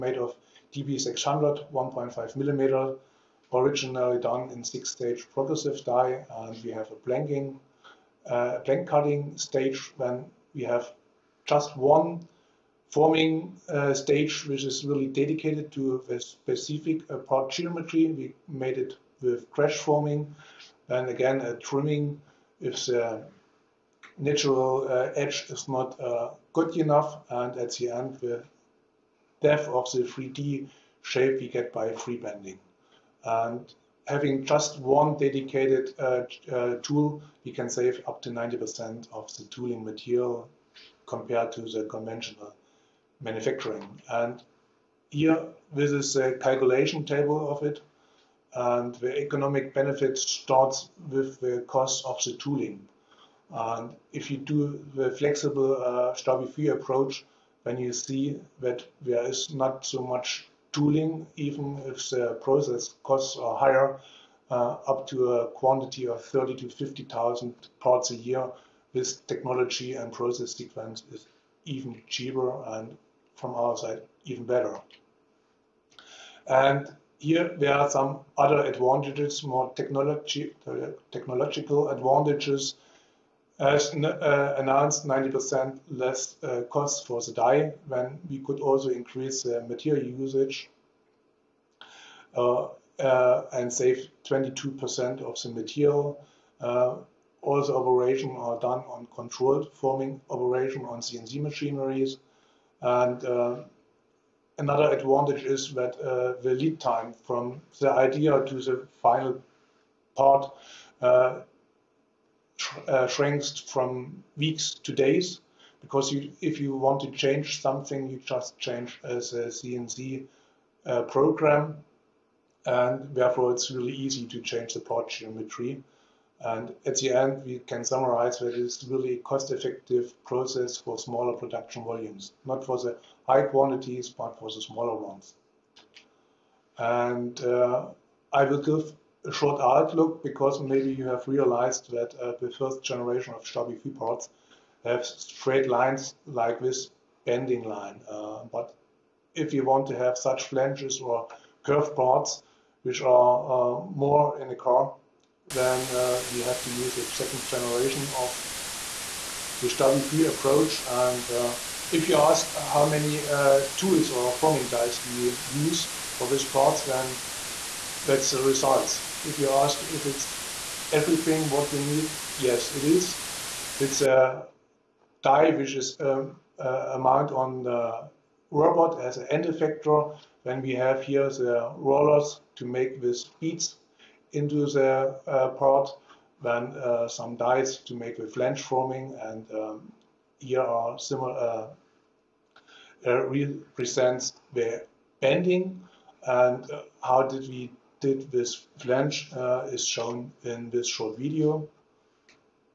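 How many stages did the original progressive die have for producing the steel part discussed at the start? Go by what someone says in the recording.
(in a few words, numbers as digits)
6.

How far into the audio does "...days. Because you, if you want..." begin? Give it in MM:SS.
01:54.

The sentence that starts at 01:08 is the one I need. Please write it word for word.
This technology and process sequence is even cheaper and from our side even better.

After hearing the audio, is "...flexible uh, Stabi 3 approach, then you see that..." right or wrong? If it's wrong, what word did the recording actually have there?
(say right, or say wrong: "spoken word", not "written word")
right.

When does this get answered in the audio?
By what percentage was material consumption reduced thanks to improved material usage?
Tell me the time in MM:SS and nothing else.
01:34.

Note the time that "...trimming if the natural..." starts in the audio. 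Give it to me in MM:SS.
00:21.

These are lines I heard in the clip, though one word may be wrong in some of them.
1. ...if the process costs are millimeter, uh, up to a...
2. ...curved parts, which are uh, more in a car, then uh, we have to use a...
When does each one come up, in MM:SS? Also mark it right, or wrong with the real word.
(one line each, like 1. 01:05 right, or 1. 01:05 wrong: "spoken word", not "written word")
1. 01:01 wrong: "higher", not "millimeter"
2. 02:31 right.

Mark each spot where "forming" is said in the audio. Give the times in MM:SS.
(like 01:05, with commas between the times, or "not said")
00:12, 00:19, 01:39, 02:44, 03:08.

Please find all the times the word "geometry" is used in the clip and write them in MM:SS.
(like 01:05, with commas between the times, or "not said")
00:17, 02:05.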